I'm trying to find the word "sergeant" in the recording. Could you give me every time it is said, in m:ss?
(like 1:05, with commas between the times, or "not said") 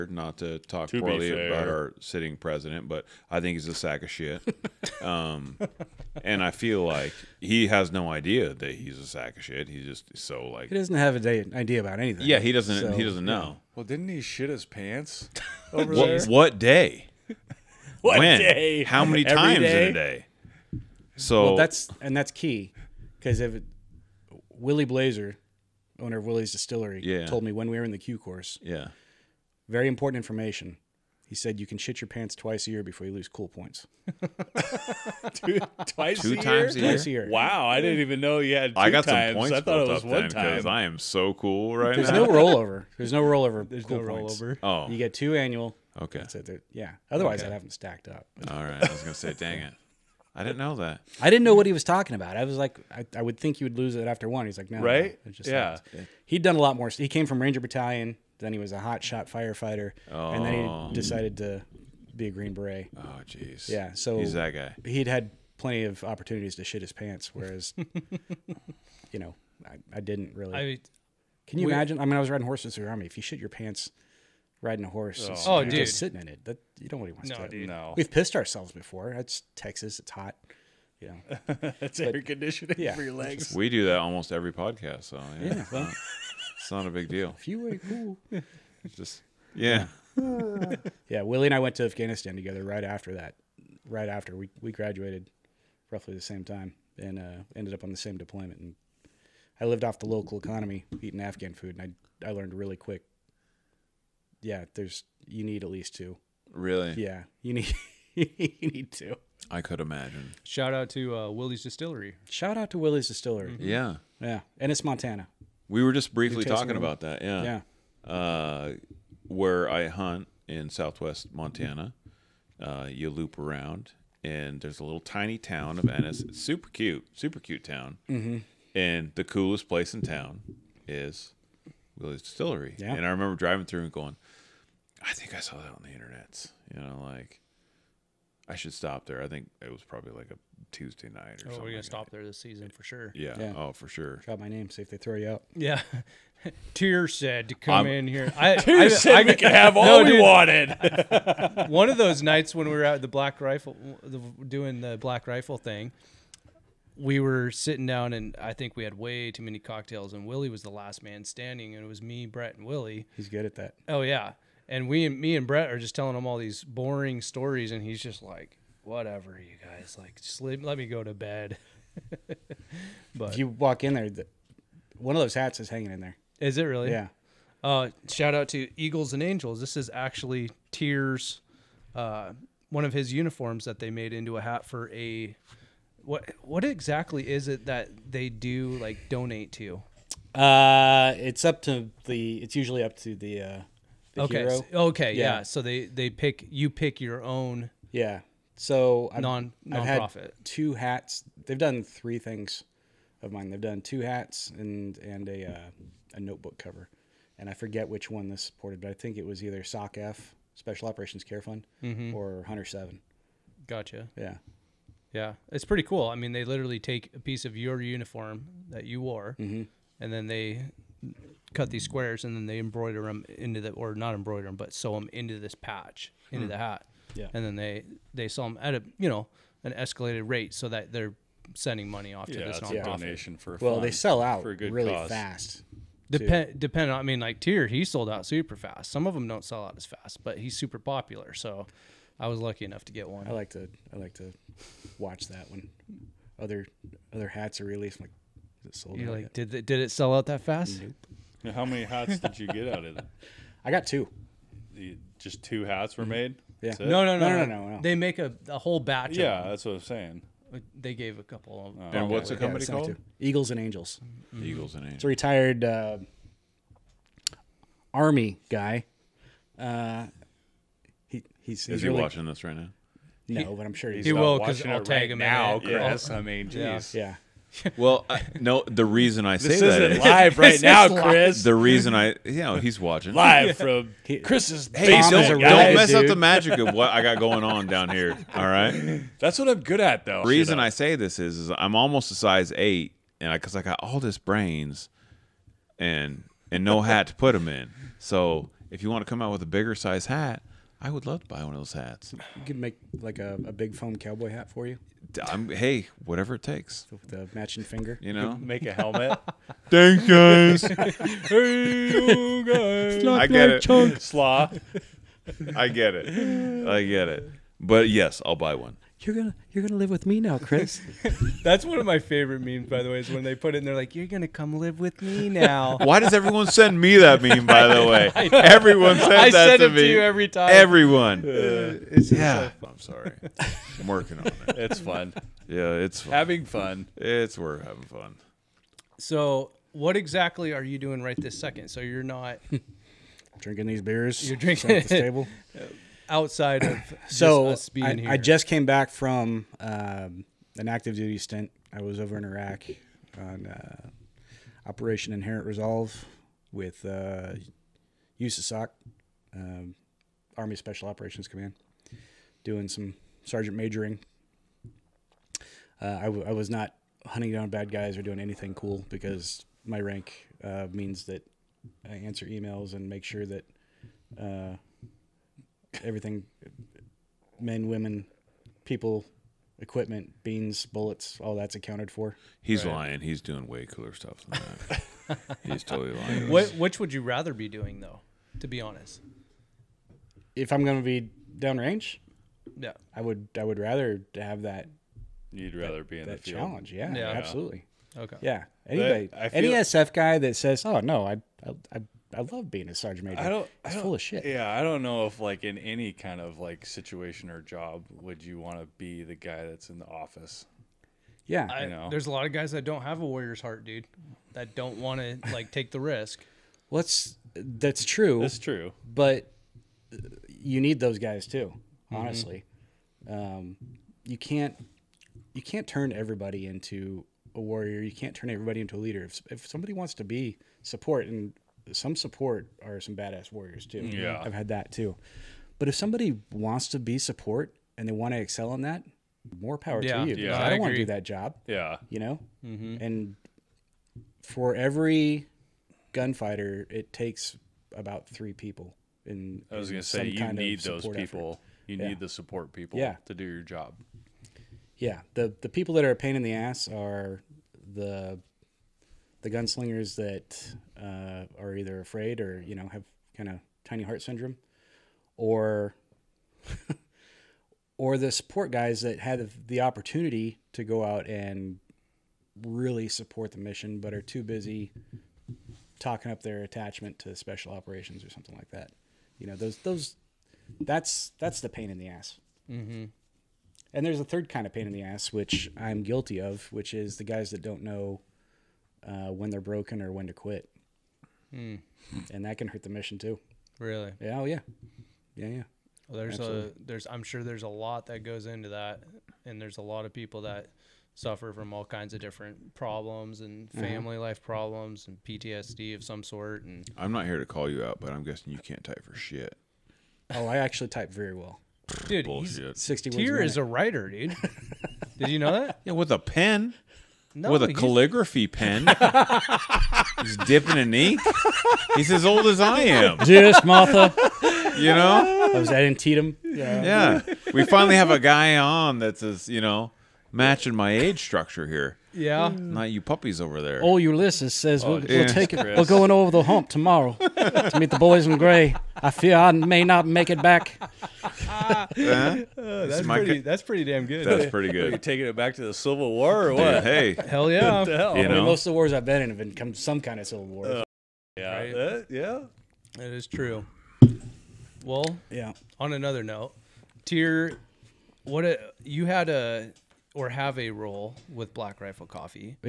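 6:03, 6:42.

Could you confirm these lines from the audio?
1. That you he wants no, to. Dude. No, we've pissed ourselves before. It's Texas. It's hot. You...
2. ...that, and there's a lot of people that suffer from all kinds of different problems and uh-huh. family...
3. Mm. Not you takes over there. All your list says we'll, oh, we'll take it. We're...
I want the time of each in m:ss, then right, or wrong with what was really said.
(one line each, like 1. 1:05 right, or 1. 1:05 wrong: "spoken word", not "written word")
1. 1:16 right
2. 8:18 right
3. 8:52 wrong: "puppies", not "takes".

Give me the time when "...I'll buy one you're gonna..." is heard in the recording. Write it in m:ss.
5:18.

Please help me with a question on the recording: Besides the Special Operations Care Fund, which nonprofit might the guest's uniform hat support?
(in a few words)
Hunter Seven.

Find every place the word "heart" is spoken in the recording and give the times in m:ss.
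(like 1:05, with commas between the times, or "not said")
6:53, 7:43.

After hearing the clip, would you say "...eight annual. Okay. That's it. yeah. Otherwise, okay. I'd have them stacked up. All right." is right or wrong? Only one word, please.
wrong.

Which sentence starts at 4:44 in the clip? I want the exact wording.
Hey, basement, don't, don't, mess dude.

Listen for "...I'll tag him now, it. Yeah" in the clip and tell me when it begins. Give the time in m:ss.
4:34.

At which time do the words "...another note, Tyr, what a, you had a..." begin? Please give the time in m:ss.
9:15.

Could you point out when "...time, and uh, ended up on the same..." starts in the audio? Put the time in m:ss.
1:36.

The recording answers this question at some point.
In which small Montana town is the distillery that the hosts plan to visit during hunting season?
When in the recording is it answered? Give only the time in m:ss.
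2:05.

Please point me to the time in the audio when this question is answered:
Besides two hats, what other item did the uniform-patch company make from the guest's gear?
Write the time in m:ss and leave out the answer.
3:26.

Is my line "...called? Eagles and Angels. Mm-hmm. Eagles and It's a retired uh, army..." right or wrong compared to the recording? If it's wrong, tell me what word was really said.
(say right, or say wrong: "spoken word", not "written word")
right.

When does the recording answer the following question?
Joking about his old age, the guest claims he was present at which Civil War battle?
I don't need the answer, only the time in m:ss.
8:45.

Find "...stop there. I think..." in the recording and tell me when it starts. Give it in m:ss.
2:18.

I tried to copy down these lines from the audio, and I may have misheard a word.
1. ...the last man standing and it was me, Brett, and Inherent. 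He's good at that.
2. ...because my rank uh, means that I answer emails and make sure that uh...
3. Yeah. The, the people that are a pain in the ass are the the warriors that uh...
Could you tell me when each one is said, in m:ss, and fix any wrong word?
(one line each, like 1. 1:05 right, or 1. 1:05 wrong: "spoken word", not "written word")
1. 2:40 wrong: "Willie", not "Inherent"
2. 6:08 right
3. 7:34 wrong: "gunslingers", not "warriors".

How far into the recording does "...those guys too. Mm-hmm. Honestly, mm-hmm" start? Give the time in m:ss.
7:00.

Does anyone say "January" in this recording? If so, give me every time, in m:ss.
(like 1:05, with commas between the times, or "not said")
not said.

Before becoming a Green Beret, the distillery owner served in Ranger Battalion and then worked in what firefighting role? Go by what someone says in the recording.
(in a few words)
hot shot firefighter.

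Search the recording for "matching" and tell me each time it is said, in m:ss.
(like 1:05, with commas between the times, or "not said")
5:07, 8:50.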